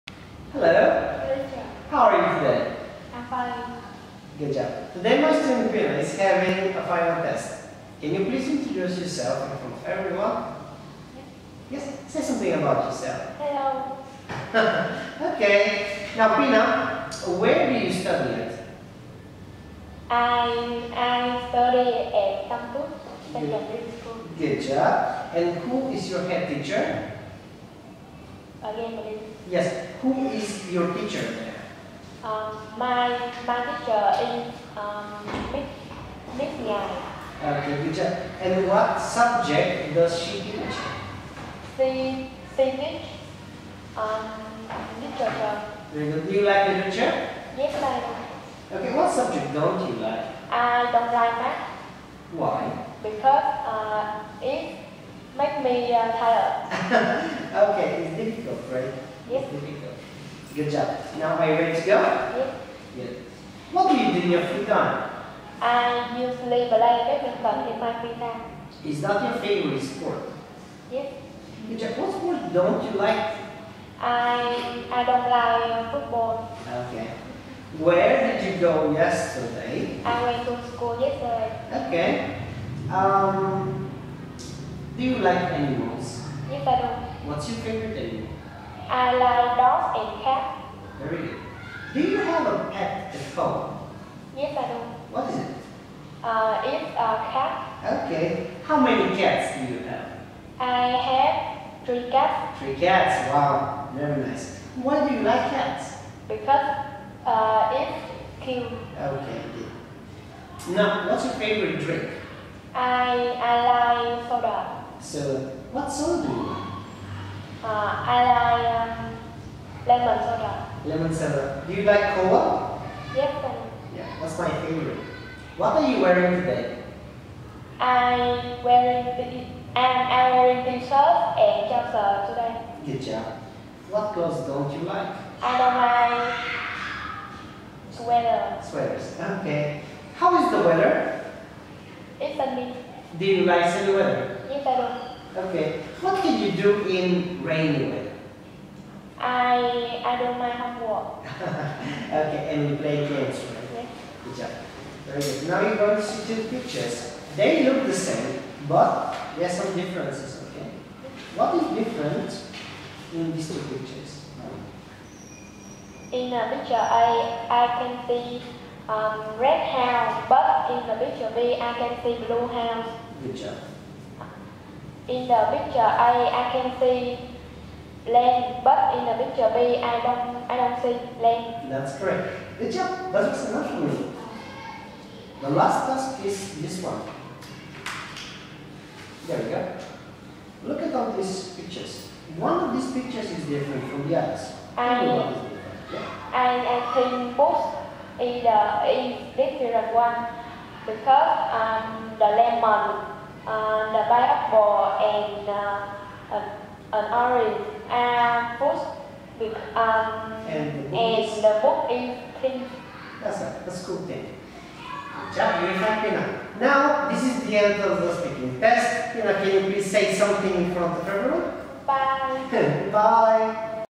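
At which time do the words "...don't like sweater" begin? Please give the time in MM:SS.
02:15.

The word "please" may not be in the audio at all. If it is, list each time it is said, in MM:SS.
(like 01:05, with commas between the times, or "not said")
00:08, 03:39.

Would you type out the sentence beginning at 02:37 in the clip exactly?
They look the same, but there are some differences, okay?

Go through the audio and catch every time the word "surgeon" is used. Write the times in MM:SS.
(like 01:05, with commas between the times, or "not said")
not said.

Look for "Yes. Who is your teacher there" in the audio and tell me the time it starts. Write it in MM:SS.
00:29.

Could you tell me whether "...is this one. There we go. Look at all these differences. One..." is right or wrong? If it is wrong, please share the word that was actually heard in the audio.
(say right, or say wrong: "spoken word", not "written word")
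wrong: "pictures", not "differences".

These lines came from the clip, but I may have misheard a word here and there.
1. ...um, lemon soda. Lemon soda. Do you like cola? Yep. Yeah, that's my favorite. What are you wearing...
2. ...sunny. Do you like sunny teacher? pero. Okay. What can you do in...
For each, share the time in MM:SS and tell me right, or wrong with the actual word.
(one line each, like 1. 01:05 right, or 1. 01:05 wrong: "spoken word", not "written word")
1. 01:58 right
2. 02:22 wrong: "weather", not "teacher".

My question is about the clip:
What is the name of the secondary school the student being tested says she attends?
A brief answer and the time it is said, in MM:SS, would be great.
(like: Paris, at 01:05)
Tampu Secondary School, at 00:22.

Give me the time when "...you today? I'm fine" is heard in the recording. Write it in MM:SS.
00:02.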